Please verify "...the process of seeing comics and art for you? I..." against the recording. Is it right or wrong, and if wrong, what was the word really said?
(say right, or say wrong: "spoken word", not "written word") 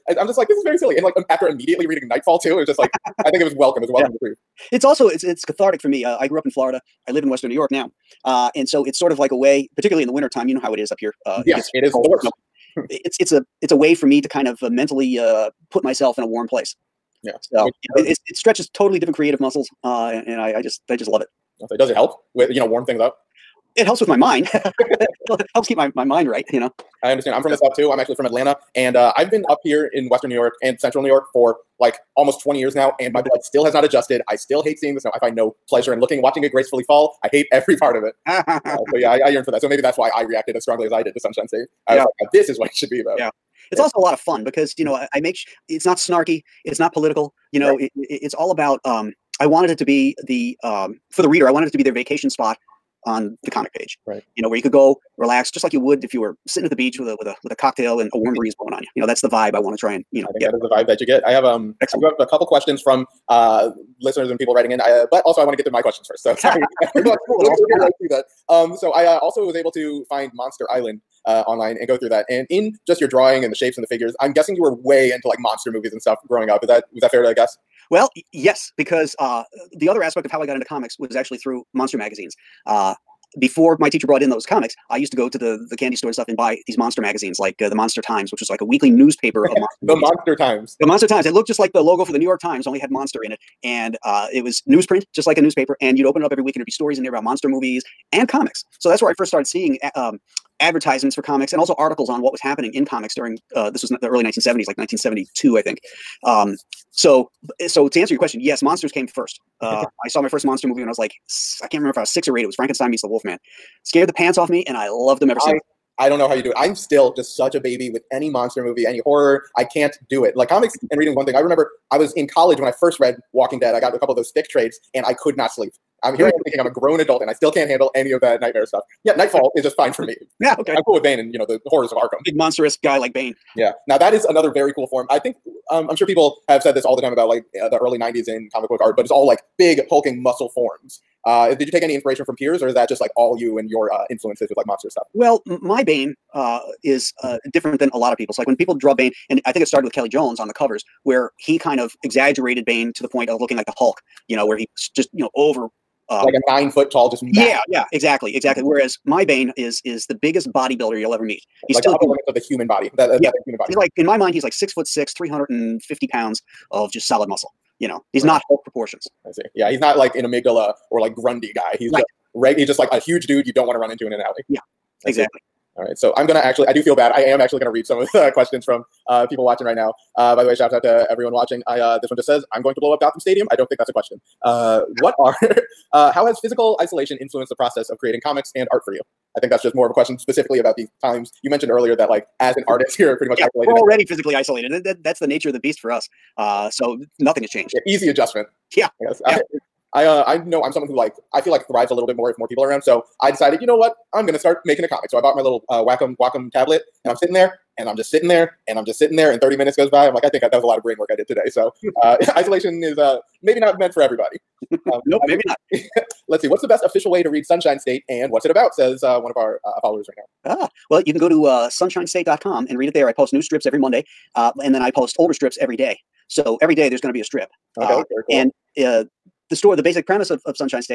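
wrong: "creating", not "seeing".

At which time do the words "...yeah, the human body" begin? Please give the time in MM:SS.
02:43.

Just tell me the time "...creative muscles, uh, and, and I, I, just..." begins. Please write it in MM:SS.
00:19.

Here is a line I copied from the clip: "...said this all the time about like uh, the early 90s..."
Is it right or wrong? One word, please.
right.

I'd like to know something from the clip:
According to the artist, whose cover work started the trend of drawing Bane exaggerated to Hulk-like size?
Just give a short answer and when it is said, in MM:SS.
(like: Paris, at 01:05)
Kelly Jones, at 02:29.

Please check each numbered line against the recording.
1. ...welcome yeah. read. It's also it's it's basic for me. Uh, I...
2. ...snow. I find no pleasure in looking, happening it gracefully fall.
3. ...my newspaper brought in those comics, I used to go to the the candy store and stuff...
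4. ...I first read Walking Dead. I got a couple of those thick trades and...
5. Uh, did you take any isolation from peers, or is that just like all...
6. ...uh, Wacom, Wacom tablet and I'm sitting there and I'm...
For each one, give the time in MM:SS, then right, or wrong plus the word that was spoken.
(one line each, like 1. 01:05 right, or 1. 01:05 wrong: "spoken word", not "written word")
1. 00:03 wrong: "cathartic", not "basic"
2. 00:34 wrong: "watching", not "happening"
3. 01:23 wrong: "teacher", not "newspaper"
4. 02:02 right
5. 02:21 wrong: "inspiration", not "isolation"
6. 03:25 right.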